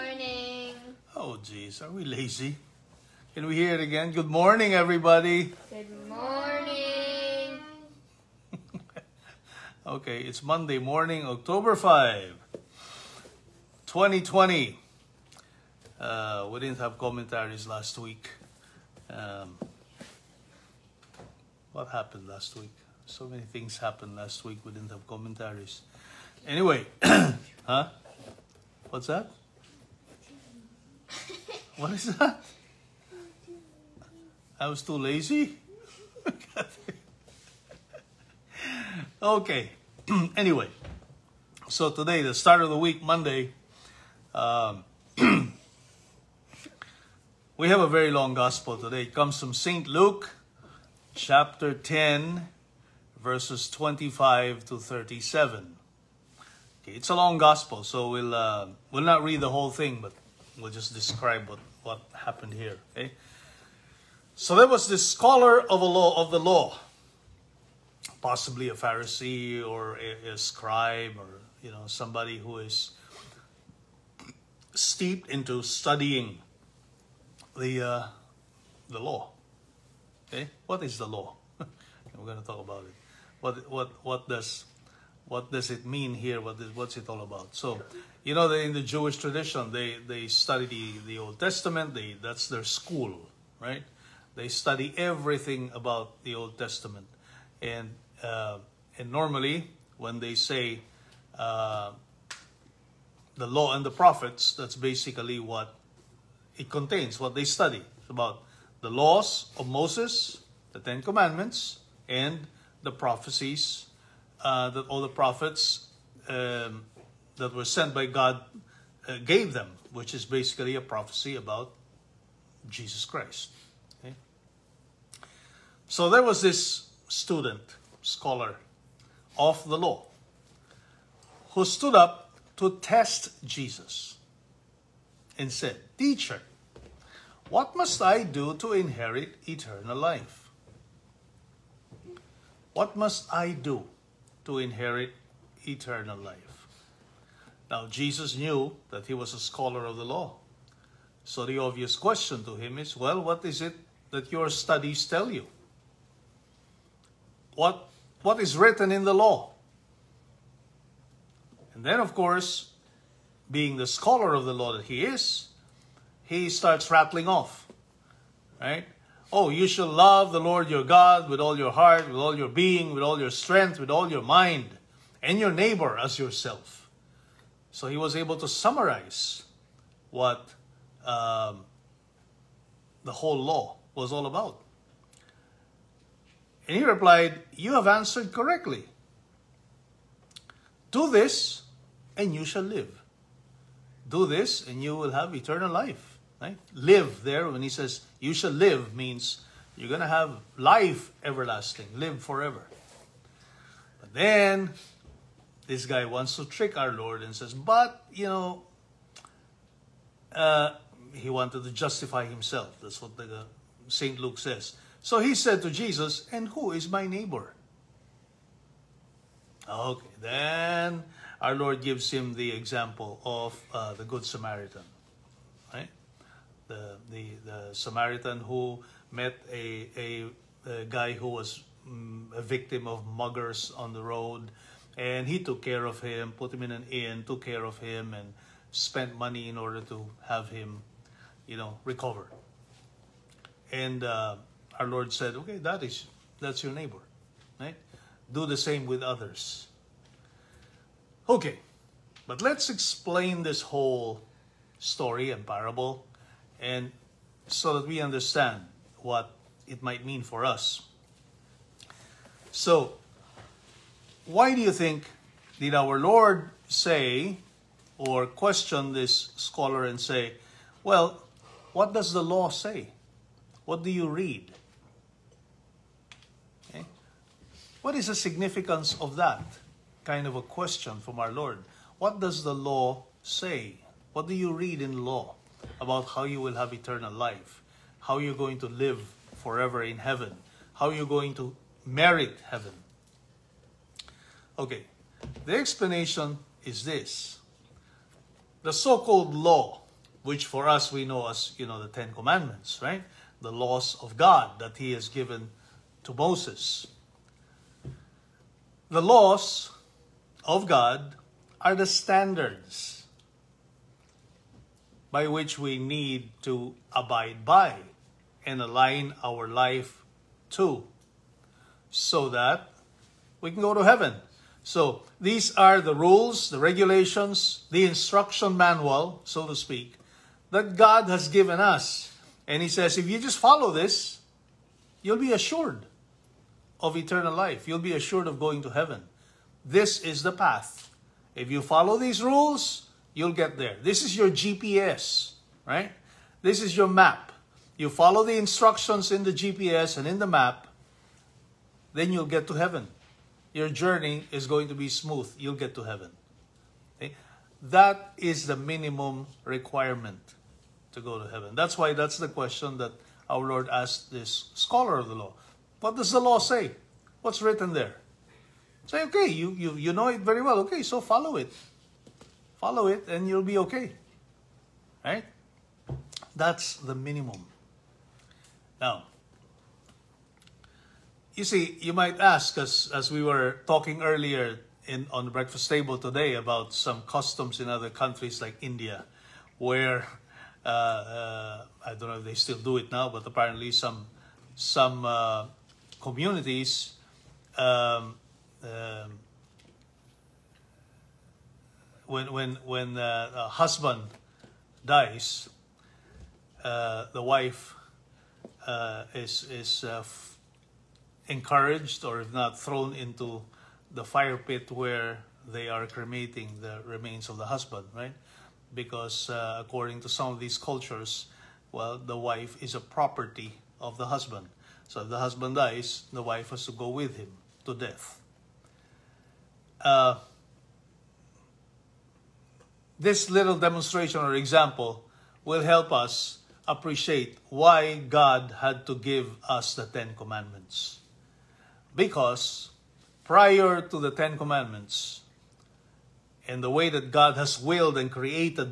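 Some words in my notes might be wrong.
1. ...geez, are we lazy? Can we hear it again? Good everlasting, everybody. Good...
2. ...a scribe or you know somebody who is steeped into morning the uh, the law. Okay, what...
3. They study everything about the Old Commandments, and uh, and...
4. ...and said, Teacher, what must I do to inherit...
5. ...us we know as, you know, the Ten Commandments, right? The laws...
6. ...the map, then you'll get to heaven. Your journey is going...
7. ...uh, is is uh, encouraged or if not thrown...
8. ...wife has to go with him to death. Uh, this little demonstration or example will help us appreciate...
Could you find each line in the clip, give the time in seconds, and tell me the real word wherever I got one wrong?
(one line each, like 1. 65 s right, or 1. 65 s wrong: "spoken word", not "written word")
1. 1 s wrong: "morning", not "everlasting"
2. 70 s wrong: "studying", not "morning"
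3. 94 s wrong: "Testament", not "Commandments"
4. 135 s right
5. 300 s right
6. 350 s right
7. 408 s right
8. 426 s right.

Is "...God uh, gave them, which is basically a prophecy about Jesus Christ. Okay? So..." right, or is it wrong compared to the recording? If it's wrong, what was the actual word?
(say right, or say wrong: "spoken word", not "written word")
right.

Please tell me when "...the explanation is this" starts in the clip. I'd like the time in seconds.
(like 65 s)
295 s.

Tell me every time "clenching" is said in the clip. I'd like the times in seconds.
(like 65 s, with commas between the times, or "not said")
not said.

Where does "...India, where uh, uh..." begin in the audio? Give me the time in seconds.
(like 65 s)
388 s.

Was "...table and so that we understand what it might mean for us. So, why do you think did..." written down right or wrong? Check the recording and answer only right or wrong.
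wrong.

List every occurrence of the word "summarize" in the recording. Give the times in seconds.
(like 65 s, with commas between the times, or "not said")
178 s.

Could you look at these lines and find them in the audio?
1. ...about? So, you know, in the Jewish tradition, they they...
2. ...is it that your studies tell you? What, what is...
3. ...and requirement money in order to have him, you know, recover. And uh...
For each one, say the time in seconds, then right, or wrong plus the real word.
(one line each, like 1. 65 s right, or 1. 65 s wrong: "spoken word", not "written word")
1. 87 s right
2. 153 s right
3. 238 s wrong: "spent", not "requirement".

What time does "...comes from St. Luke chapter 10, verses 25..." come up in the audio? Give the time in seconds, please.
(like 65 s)
49 s.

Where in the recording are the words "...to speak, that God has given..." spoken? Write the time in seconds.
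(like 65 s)
329 s.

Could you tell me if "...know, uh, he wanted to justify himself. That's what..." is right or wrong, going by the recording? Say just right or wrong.
right.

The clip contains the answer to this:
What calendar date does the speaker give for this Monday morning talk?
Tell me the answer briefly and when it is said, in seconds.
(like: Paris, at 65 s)
October 5, 2020, at 11 s.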